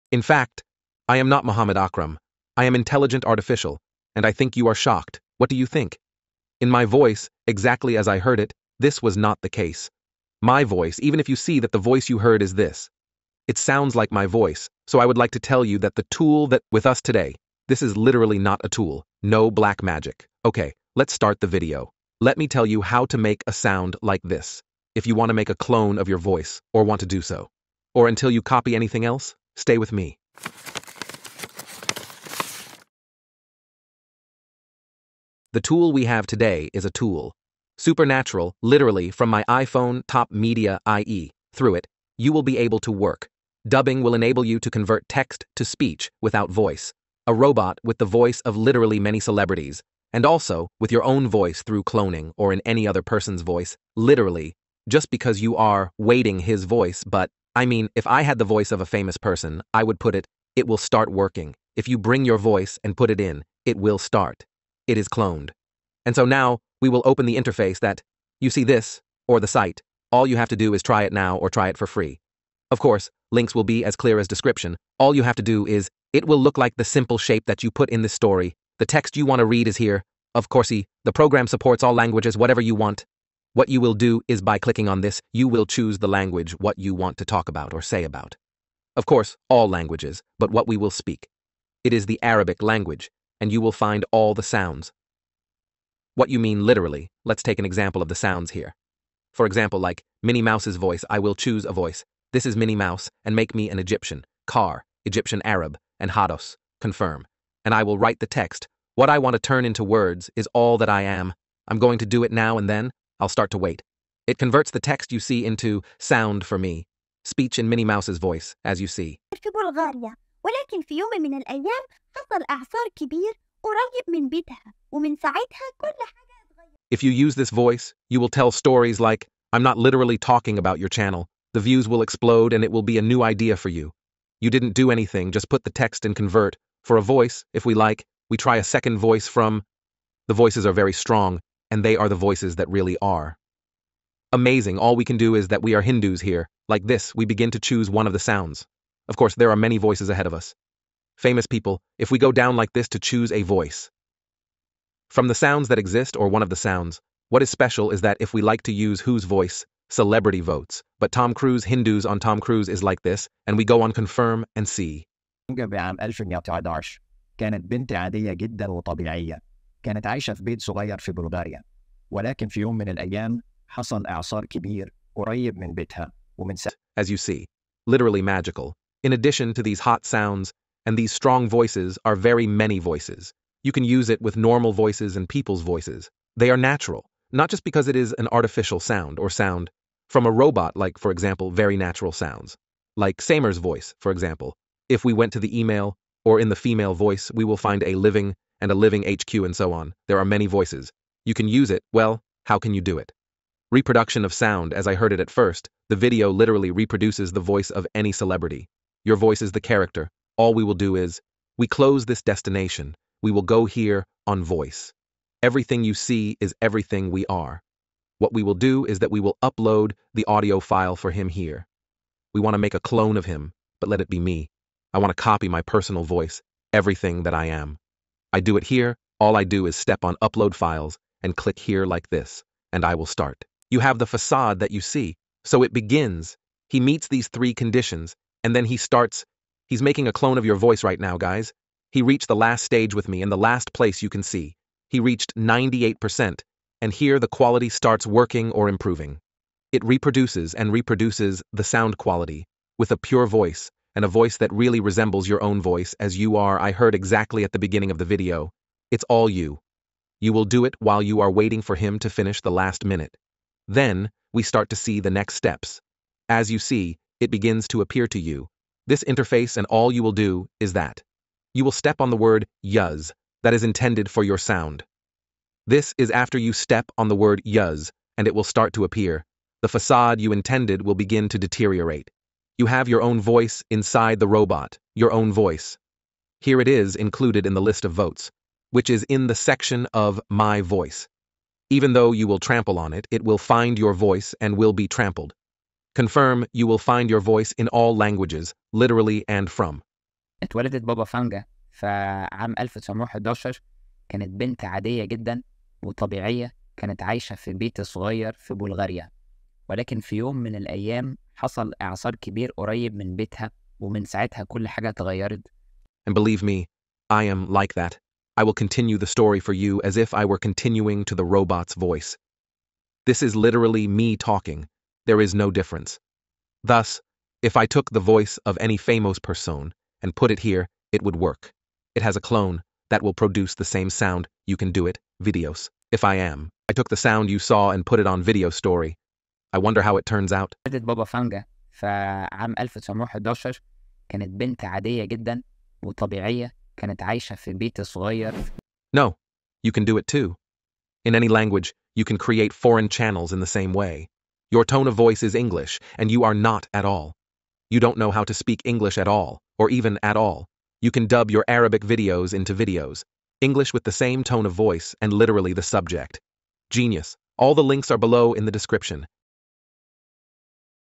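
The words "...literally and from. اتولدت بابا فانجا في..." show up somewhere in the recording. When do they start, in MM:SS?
04:58.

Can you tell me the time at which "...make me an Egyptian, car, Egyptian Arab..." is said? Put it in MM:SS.
01:43.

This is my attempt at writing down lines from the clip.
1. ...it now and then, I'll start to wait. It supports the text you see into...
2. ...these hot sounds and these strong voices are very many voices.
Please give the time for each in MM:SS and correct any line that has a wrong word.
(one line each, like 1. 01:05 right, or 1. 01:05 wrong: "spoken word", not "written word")
1. 01:52 wrong: "converts", not "supports"
2. 02:59 right.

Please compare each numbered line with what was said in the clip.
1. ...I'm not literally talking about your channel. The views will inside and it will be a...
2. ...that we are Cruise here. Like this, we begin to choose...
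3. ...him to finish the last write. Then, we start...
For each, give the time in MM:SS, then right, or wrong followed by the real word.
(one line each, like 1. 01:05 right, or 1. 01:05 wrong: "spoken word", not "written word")
1. 02:09 wrong: "explode", not "inside"
2. 02:25 wrong: "Hindus", not "Cruise"
3. 04:21 wrong: "minute", not "write".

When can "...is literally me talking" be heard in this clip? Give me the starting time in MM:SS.
05:23.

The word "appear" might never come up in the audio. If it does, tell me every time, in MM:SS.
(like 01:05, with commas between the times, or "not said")
04:27, 04:38.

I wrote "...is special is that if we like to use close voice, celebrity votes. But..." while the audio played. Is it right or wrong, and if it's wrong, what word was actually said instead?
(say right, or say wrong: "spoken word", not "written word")
wrong: "whose", not "close".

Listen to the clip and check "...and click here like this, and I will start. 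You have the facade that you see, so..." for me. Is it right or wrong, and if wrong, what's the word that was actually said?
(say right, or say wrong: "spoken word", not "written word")
right.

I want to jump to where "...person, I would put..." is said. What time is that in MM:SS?
00:59.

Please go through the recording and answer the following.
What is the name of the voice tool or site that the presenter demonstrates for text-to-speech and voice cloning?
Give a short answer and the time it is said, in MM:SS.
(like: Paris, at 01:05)
TopMediai, at 00:40.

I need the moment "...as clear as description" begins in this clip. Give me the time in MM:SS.
01:13.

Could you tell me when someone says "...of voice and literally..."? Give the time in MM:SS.
06:04.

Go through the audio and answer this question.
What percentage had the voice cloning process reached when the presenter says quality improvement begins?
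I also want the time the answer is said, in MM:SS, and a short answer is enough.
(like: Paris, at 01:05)
98%, at 04:05.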